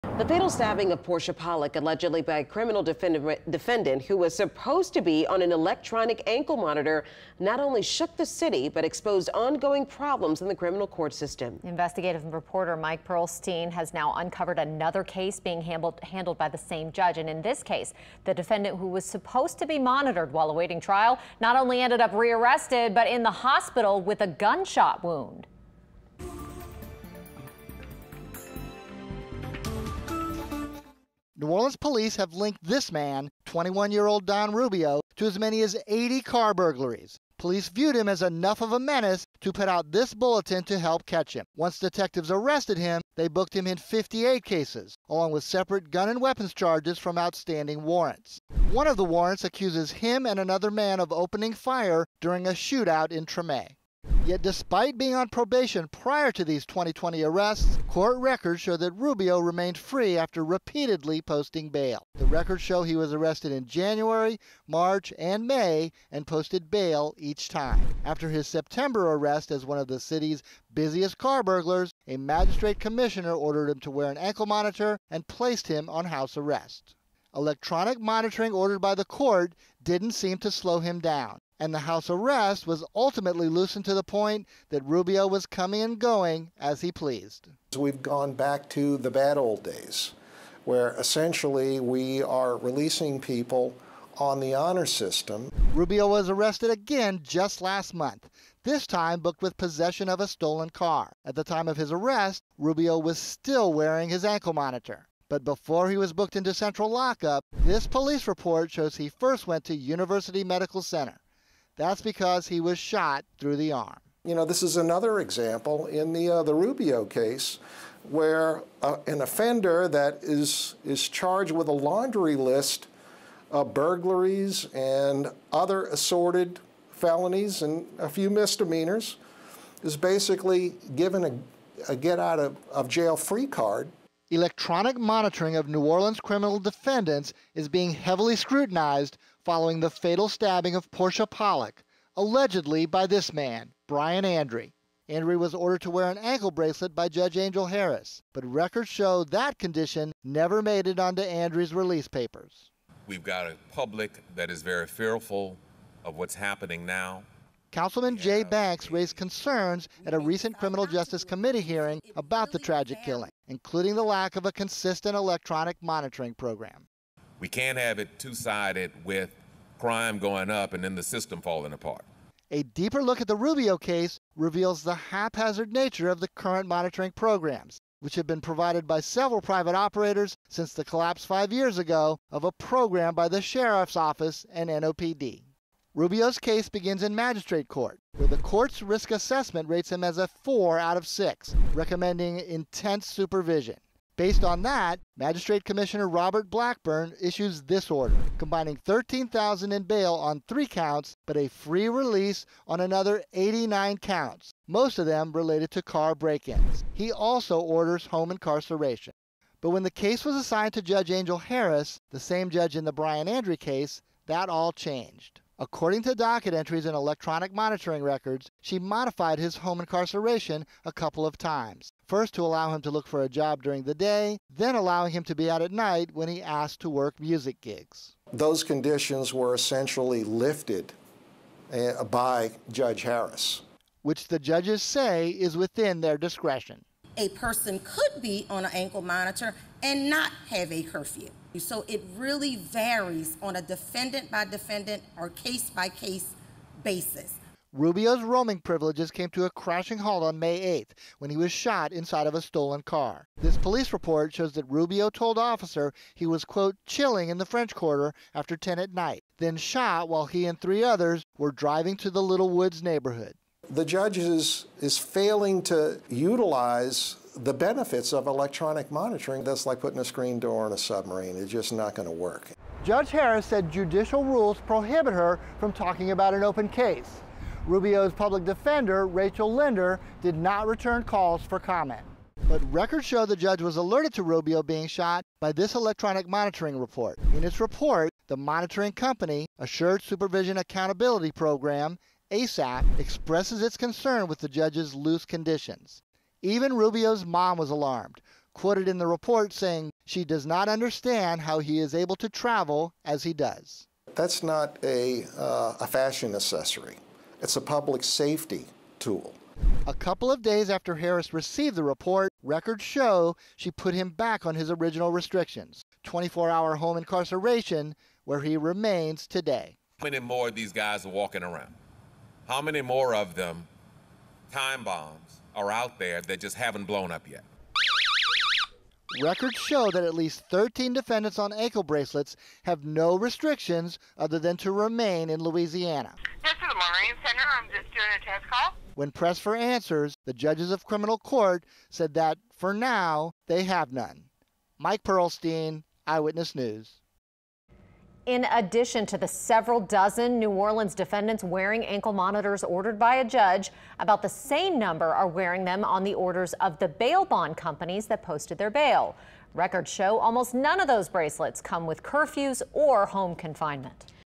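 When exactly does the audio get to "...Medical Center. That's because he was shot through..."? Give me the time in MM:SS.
01:50.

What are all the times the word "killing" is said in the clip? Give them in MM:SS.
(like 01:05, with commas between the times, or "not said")
02:43.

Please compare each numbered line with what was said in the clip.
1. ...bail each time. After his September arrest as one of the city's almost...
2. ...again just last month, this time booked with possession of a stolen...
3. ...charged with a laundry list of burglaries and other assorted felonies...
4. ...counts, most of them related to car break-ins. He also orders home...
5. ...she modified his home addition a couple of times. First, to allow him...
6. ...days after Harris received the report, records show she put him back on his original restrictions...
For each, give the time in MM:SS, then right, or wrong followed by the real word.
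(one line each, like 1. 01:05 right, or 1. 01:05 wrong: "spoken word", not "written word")
1. 01:06 wrong: "busiest", not "almost"
2. 01:36 right
3. 02:01 right
4. 03:23 right
5. 03:38 wrong: "incarceration", not "addition"
6. 05:10 right.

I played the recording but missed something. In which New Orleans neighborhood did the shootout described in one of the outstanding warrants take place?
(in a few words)
Treme.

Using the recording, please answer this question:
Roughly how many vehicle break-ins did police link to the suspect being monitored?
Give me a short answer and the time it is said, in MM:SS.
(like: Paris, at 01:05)
80, at 00:35.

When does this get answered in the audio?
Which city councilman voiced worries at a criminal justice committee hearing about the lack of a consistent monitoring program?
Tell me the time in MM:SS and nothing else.
02:38.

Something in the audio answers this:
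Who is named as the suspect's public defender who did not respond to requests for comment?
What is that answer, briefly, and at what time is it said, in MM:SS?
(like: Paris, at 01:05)
Rachel Linder, at 04:39.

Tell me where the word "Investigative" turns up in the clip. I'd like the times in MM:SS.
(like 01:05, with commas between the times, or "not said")
00:11.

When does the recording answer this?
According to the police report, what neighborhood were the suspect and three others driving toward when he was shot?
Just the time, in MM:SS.
04:22.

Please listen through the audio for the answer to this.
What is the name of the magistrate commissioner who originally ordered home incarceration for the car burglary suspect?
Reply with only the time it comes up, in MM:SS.
03:16.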